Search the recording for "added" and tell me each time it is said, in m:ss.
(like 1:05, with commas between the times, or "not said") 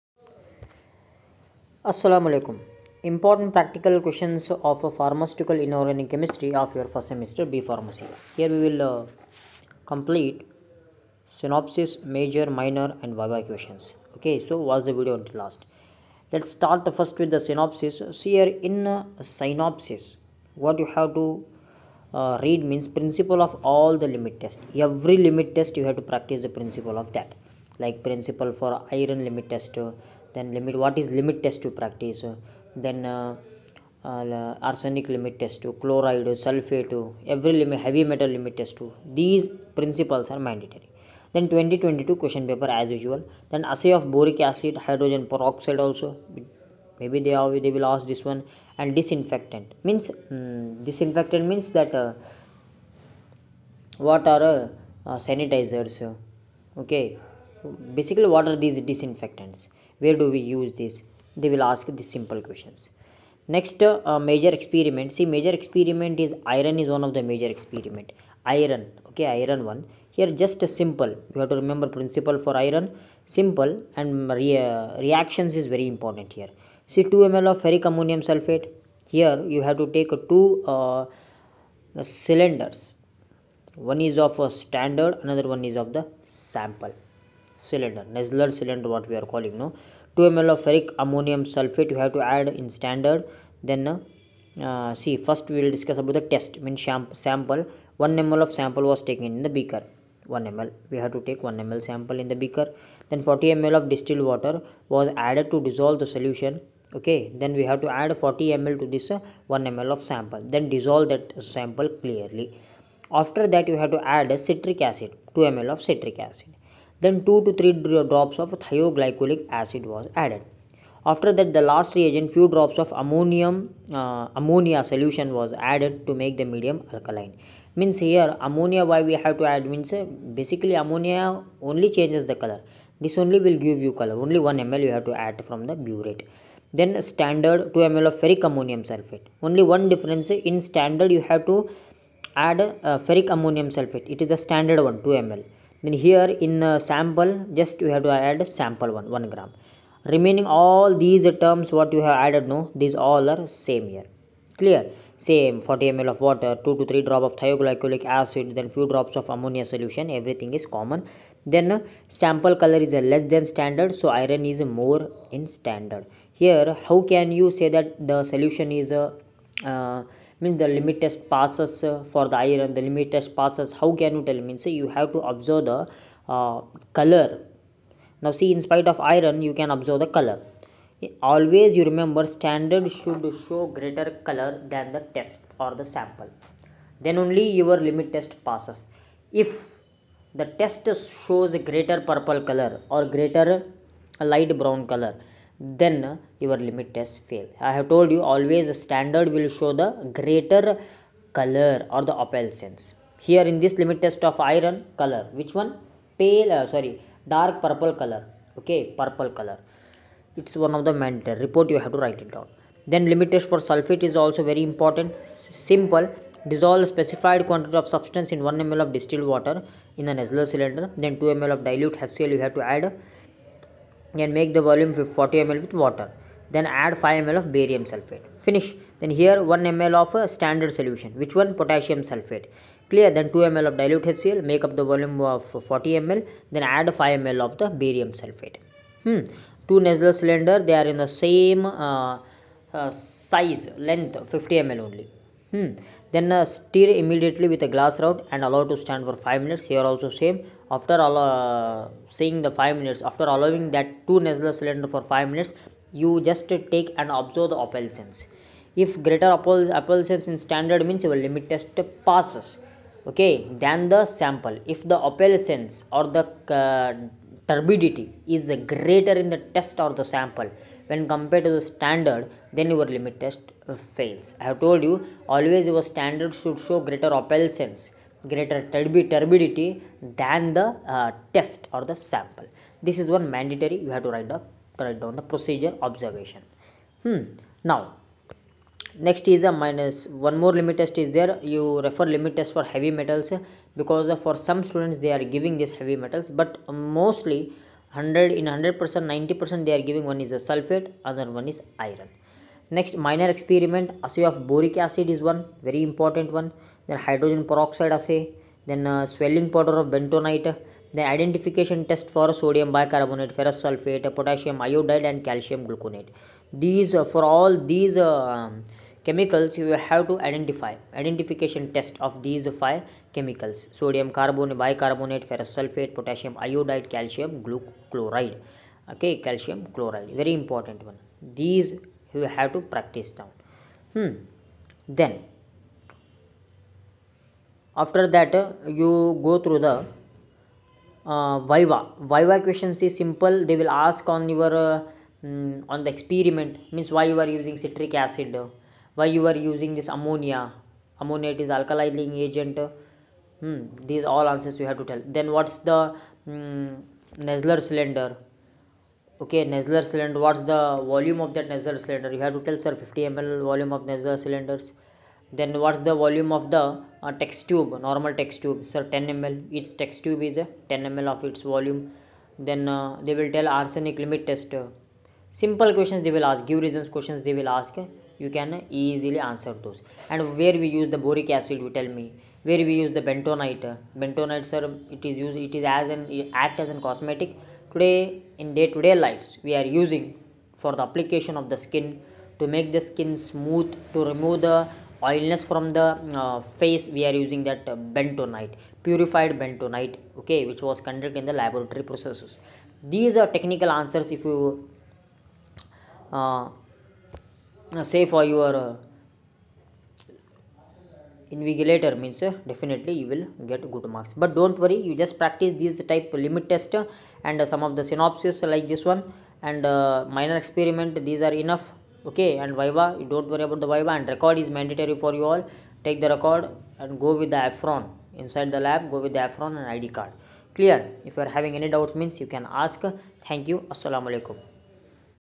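1:45, 2:00, 2:05, 2:32.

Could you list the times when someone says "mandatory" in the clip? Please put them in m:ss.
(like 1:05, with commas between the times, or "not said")
0:40, 3:31, 4:43, 7:04.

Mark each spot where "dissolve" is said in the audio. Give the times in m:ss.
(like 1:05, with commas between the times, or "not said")
1:45, 1:50, 3:36.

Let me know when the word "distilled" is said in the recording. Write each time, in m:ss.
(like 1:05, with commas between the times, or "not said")
1:43, 3:38.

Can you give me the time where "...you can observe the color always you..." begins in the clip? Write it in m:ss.
2:59.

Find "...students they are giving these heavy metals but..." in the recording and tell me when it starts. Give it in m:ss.
4:54.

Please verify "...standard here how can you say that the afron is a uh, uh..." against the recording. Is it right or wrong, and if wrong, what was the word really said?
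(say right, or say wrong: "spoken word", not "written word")
wrong: "solution", not "afron".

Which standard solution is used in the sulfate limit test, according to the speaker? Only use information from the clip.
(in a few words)
Potassium sulfate.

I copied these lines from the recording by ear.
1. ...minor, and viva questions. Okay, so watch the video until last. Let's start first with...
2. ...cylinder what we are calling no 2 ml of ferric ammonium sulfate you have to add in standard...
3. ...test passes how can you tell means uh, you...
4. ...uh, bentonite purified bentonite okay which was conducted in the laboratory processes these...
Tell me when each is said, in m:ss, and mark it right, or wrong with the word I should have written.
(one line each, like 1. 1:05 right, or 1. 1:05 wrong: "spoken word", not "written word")
1. 0:12 right
2. 1:28 right
3. 2:53 right
4. 6:37 right.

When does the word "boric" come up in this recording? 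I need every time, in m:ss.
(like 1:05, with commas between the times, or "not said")
0:44, 5:04, 6:21.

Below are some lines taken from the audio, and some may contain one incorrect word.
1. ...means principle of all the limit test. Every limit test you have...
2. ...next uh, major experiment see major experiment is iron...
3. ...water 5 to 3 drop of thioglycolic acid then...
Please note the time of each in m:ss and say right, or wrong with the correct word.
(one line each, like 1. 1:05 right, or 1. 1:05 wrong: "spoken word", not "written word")
1. 0:22 right
2. 1:03 right
3. 2:36 wrong: "2", not "5".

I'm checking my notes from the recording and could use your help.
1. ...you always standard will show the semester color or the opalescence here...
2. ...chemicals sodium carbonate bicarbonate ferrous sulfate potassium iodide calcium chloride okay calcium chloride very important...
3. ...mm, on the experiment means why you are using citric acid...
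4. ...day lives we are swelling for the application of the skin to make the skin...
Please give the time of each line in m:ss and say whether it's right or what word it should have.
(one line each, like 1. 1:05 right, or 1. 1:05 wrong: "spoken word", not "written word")
1. 3:18 wrong: "greater", not "semester"
2. 5:23 right
3. 5:45 right
4. 6:28 wrong: "using", not "swelling".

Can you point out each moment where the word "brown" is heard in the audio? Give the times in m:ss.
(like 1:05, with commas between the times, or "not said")
3:14.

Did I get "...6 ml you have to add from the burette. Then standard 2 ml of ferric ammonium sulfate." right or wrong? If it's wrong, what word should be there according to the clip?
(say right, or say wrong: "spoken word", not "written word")
wrong: "1", not "6".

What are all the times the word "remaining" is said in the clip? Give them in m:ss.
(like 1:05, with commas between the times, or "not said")
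2:30.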